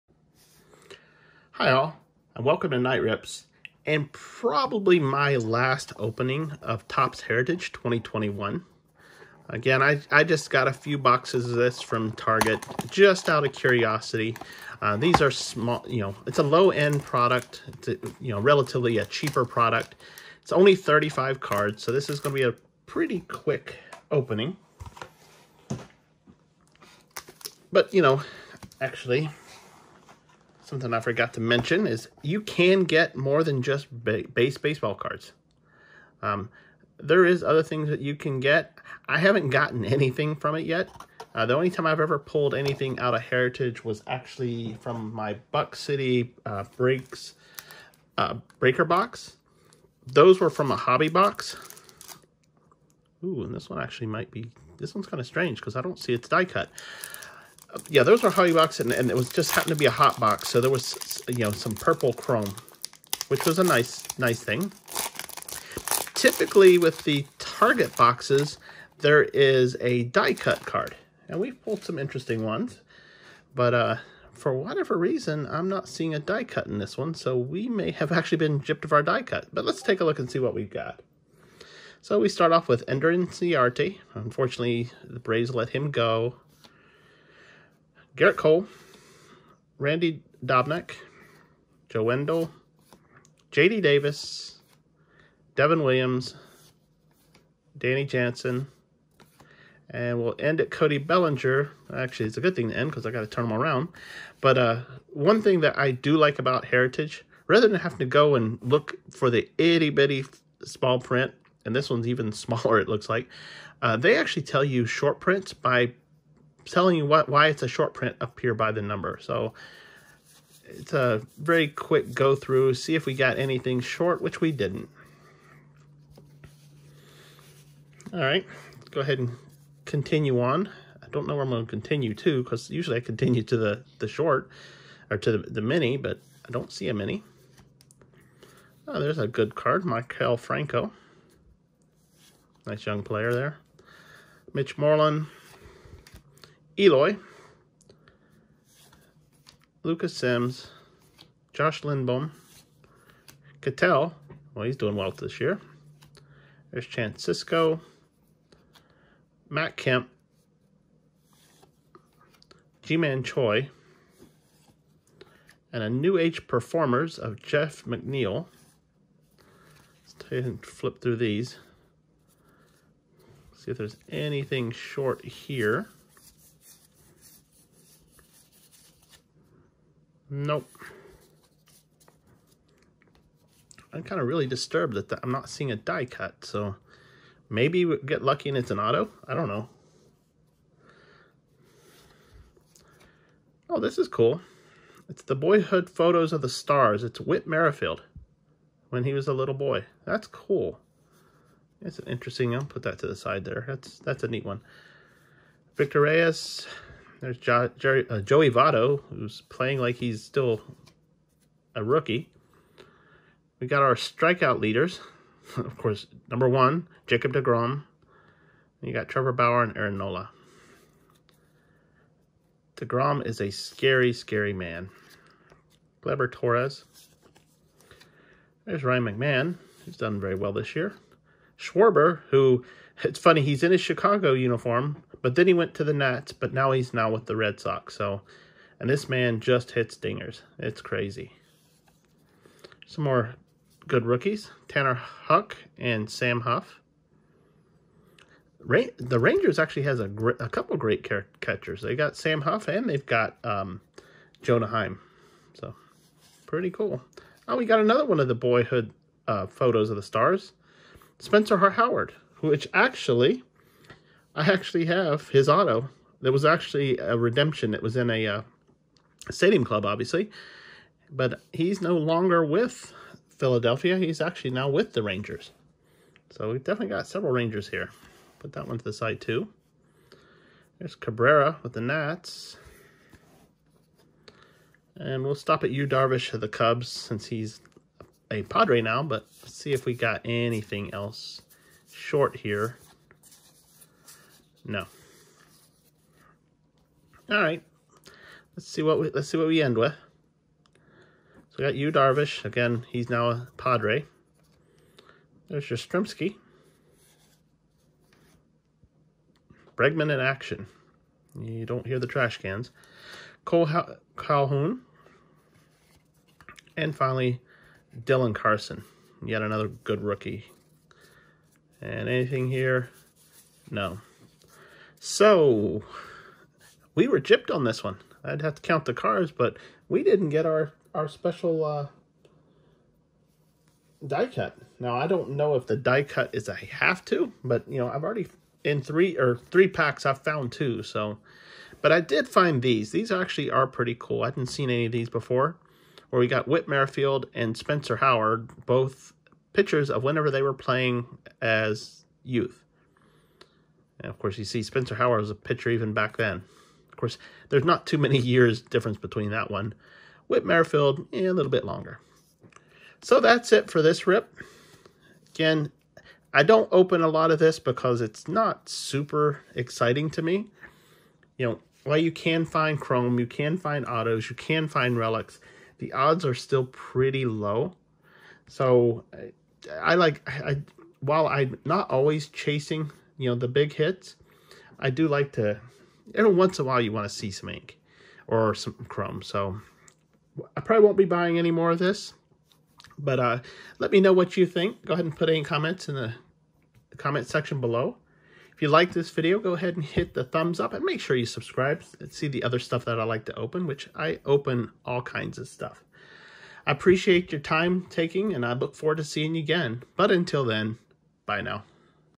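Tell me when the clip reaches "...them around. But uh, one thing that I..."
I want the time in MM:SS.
01:43.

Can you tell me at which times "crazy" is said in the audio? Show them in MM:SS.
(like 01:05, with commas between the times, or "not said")
04:00.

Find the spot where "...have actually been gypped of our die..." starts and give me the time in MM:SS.
01:17.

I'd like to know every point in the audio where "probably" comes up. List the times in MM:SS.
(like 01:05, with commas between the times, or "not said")
00:04, 06:30.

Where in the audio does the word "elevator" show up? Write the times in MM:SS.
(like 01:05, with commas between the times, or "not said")
not said.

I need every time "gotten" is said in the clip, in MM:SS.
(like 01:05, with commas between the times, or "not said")
00:39.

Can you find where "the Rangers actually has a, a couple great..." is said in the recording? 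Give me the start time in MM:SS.
04:08.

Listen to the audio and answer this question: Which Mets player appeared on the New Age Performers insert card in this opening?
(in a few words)
Jeff McNeil.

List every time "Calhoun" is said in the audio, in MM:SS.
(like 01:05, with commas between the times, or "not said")
05:14.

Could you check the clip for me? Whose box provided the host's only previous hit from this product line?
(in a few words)
Buck City.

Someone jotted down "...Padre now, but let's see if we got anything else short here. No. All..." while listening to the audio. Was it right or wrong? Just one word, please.
right.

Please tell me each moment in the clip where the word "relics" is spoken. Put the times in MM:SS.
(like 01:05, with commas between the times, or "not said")
06:14.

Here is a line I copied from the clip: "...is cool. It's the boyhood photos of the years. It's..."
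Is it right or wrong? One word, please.
wrong.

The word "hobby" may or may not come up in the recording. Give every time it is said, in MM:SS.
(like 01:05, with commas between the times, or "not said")
00:50, 00:58.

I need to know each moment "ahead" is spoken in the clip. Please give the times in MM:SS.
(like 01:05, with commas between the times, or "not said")
02:08, 06:34, 06:39.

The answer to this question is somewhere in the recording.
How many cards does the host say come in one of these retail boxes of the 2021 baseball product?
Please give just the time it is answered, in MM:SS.
00:20.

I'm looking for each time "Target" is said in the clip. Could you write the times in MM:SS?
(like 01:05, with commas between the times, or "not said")
00:12, 01:07.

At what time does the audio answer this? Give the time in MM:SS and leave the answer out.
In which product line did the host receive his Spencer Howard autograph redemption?
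04:29.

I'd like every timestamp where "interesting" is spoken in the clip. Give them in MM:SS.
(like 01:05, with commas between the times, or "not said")
01:11, 03:22.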